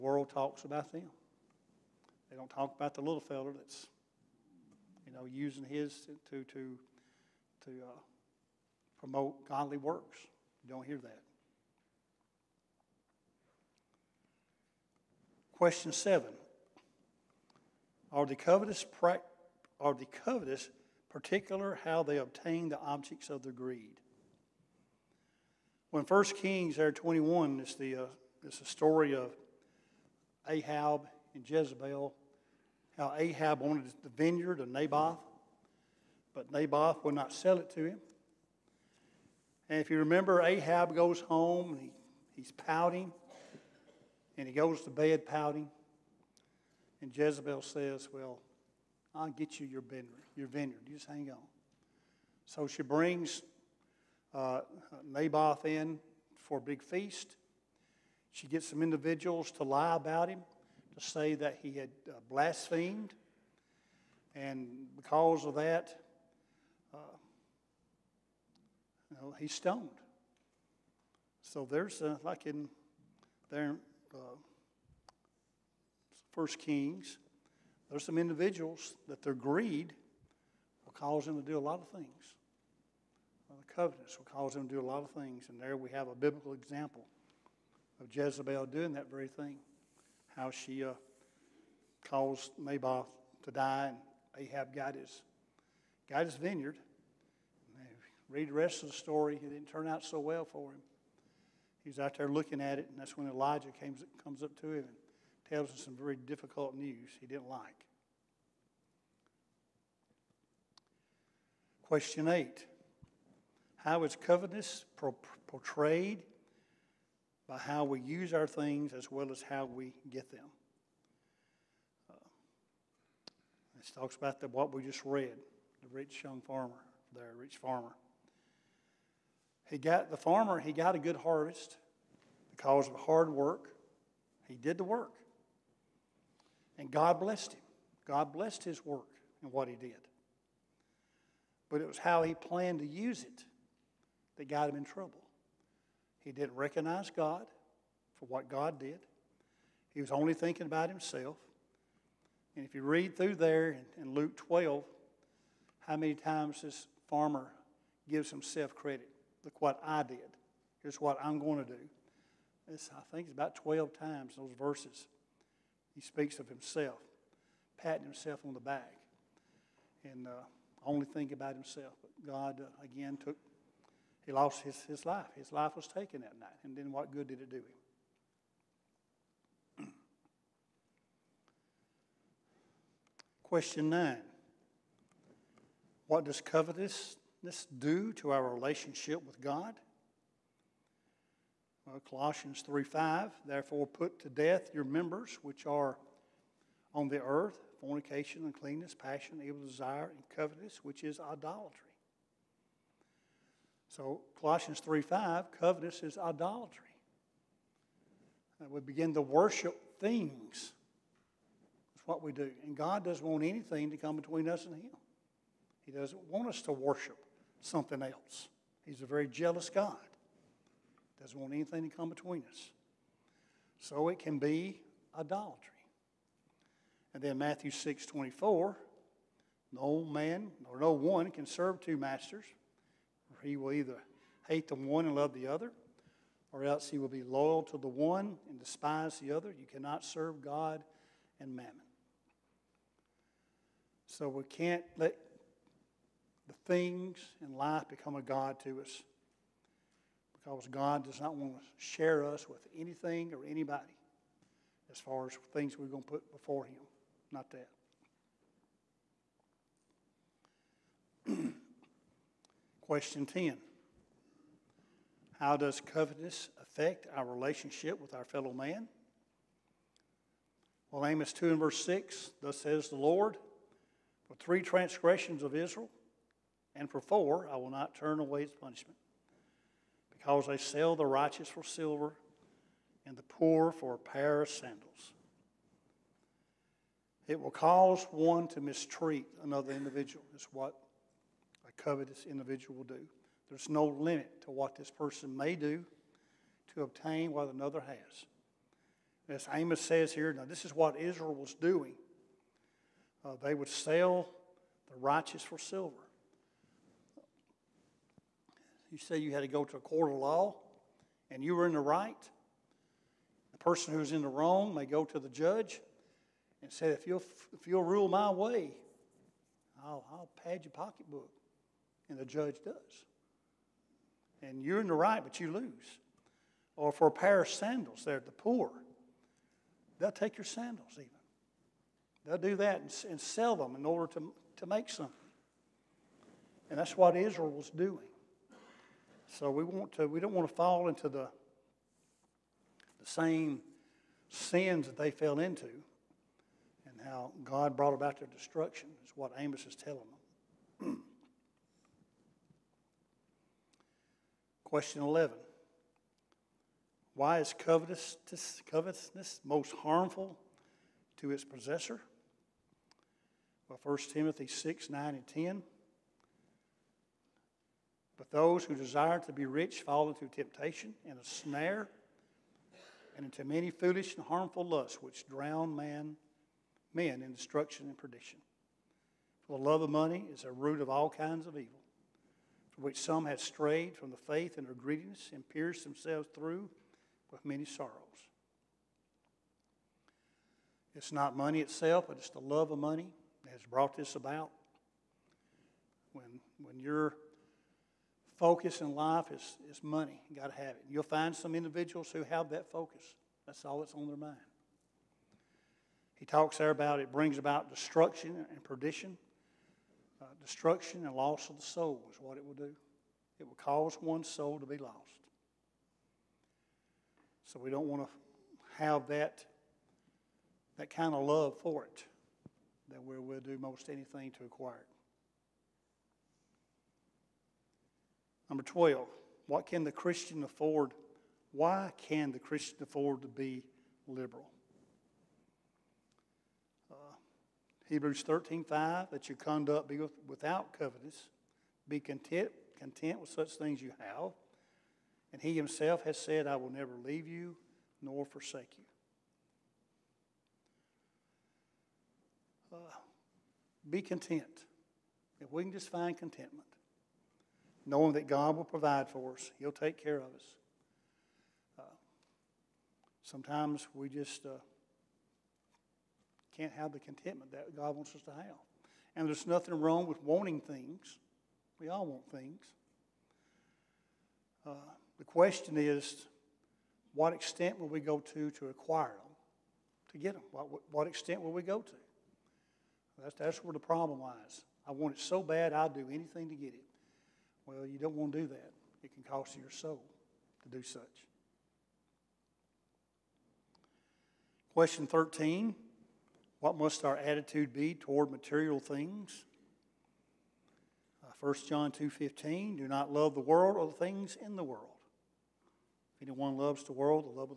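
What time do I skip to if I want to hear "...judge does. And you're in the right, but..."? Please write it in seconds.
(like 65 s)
322 s.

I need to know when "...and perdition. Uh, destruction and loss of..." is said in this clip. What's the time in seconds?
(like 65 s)
408 s.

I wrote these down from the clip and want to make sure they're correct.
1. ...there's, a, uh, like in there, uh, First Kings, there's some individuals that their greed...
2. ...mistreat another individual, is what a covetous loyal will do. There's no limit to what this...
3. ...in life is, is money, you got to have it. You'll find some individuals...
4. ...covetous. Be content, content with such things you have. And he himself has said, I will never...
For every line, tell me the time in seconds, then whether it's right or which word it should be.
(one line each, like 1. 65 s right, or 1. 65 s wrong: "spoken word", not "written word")
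1. 71 s right
2. 288 s wrong: "individual", not "loyal"
3. 398 s right
4. 440 s right.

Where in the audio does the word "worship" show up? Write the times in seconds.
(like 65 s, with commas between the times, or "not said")
209 s, 216 s.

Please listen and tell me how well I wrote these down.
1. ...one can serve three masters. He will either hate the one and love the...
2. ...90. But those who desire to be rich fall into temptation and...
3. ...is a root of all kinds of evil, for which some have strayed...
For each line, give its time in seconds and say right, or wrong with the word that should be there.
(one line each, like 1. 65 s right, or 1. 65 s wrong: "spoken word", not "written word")
1. 230 s wrong: "two", not "three"
2. 365 s wrong: "10", not "90"
3. 380 s right.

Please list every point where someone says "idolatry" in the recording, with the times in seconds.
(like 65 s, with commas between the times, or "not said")
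201 s, 206 s, 225 s.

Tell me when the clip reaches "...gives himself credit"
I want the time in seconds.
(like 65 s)
158 s.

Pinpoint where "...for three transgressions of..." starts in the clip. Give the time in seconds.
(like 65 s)
274 s.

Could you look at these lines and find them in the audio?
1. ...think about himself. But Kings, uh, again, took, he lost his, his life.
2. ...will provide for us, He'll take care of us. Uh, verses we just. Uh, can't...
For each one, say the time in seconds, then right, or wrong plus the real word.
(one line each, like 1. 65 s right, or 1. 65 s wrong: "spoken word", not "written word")
1. 171 s wrong: "God", not "Kings"
2. 458 s wrong: "sometimes", not "verses".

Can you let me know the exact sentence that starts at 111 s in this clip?
Question eight How is covetousness portrayed by how we use our things as well as how we get them?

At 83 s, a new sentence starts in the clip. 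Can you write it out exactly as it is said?
The covenants will cause them to do a lot of things.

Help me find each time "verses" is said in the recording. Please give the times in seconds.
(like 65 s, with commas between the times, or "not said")
164 s, 271 s.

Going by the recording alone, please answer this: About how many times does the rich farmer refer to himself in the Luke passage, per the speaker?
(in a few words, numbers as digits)
12.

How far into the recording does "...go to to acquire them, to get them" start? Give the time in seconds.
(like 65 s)
477 s.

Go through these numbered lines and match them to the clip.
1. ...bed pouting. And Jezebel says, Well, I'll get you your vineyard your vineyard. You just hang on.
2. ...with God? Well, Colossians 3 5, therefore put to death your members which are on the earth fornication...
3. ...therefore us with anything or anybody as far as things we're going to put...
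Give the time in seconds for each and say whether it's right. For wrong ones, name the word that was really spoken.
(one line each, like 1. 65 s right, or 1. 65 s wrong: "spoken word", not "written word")
1. 44 s right
2. 189 s right
3. 251 s wrong: "share", not "therefore".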